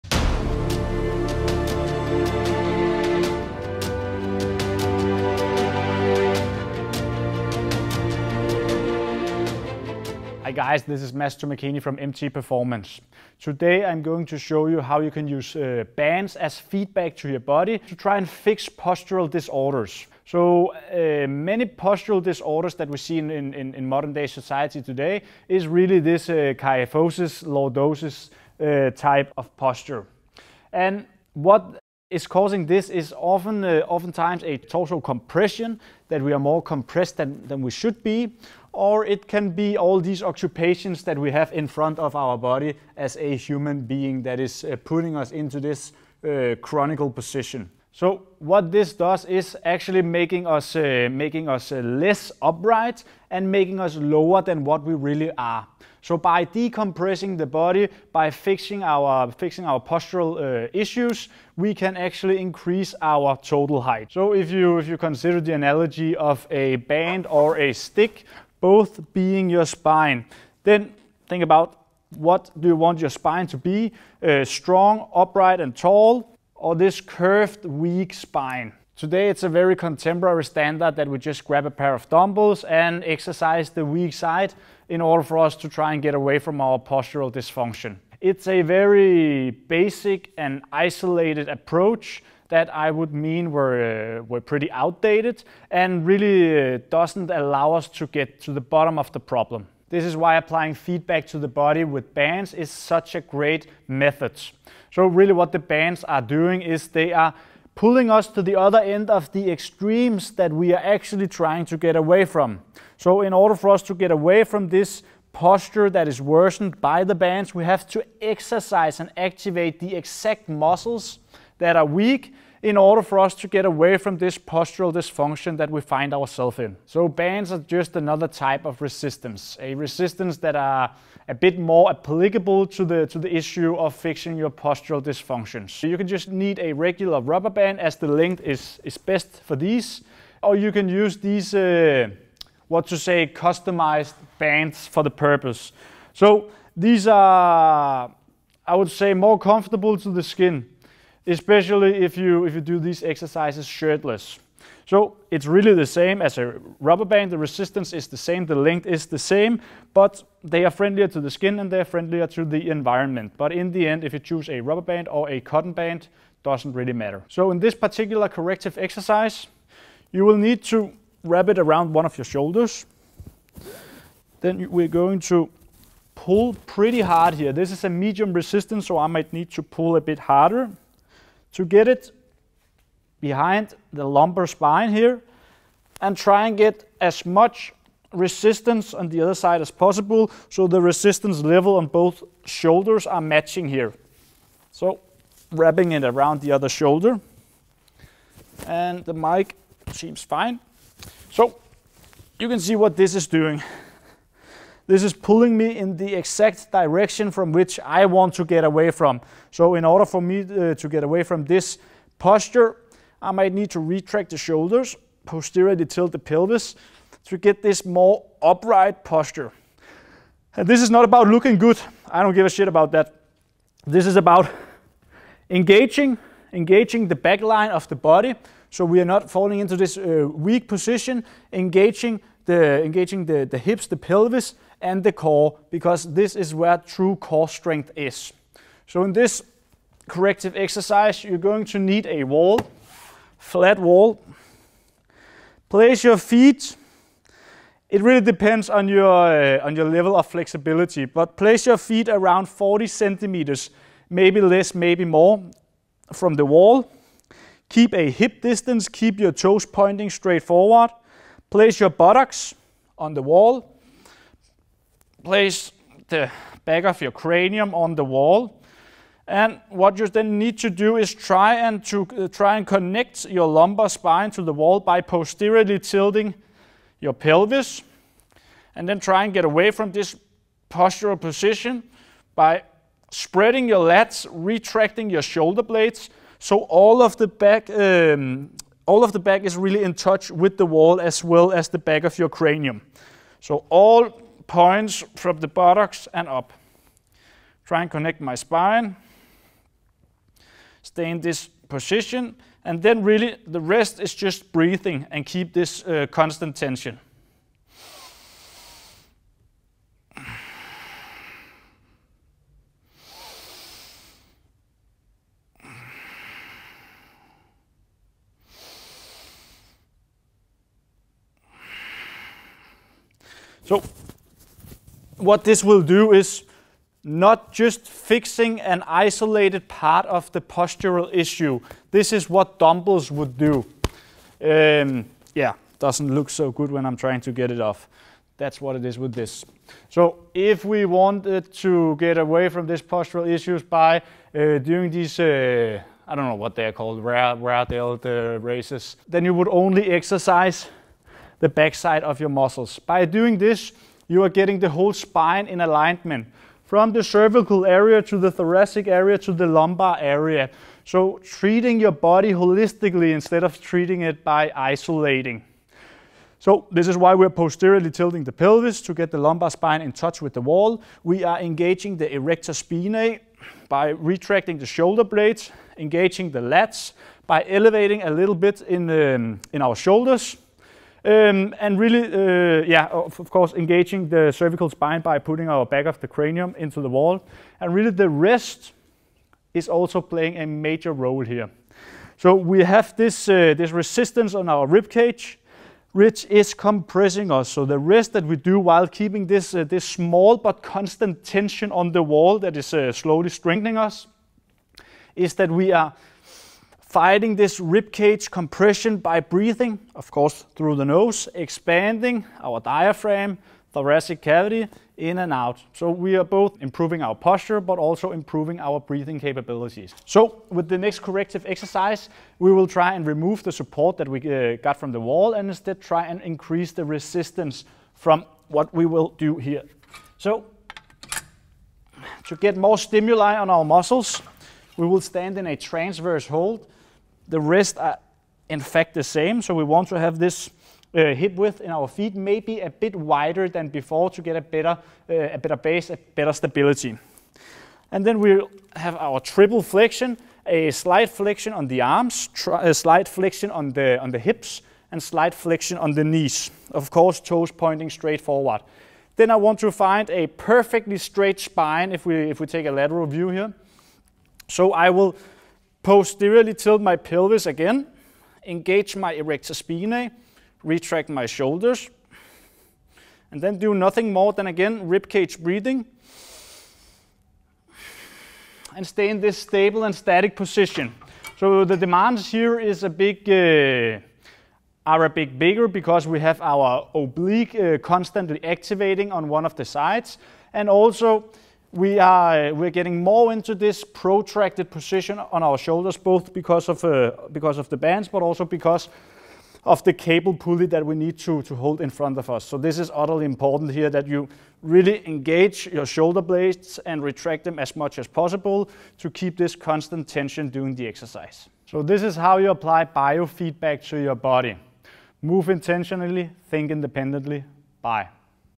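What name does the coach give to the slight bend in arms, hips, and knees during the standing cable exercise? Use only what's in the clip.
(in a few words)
triple flexion.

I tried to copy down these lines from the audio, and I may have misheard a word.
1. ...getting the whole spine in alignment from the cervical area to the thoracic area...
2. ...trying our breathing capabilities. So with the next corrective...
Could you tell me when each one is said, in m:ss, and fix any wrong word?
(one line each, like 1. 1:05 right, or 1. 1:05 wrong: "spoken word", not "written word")
1. 5:54 right
2. 6:58 wrong: "improving", not "trying".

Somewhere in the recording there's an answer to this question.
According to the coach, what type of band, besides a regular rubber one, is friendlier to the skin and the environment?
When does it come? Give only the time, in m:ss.
2:45.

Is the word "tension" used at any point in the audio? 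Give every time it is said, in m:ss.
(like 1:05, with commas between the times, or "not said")
5:06, 6:41, 8:30.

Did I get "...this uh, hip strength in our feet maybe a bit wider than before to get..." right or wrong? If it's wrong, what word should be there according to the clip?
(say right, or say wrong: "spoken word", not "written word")
wrong: "width", not "strength".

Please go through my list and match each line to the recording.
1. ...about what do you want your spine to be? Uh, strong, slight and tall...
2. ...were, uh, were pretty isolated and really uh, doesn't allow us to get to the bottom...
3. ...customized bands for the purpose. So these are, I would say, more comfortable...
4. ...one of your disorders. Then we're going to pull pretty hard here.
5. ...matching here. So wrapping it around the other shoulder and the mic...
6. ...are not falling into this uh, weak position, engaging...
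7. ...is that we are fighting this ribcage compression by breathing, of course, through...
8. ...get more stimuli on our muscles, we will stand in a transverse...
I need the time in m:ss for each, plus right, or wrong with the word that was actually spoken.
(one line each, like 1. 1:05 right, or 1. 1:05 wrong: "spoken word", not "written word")
1. 1:11 wrong: "upright", not "slight"
2. 1:33 wrong: "outdated", not "isolated"
3. 2:23 right
4. 2:51 wrong: "shoulders", not "disorders"
5. 3:13 right
6. 3:48 right
7. 6:45 right
8. 7:12 right.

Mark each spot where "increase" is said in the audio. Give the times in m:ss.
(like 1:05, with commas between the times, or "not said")
1:02, 7:06.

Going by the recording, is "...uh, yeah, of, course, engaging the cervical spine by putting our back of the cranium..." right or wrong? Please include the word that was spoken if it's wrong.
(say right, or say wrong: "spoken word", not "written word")
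right.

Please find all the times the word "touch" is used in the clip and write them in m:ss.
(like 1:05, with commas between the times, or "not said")
4:49, 6:09.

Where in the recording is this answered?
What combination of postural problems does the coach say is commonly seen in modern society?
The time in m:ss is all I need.
0:26.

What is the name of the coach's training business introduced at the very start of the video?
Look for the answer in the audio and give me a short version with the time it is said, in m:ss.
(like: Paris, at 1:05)
MT Performance, at 0:11.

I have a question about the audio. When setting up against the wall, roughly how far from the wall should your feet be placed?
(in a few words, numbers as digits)
40 centimeters.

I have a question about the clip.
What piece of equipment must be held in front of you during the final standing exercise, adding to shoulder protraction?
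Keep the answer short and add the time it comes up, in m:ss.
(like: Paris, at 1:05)
cable pulley, at 8:19.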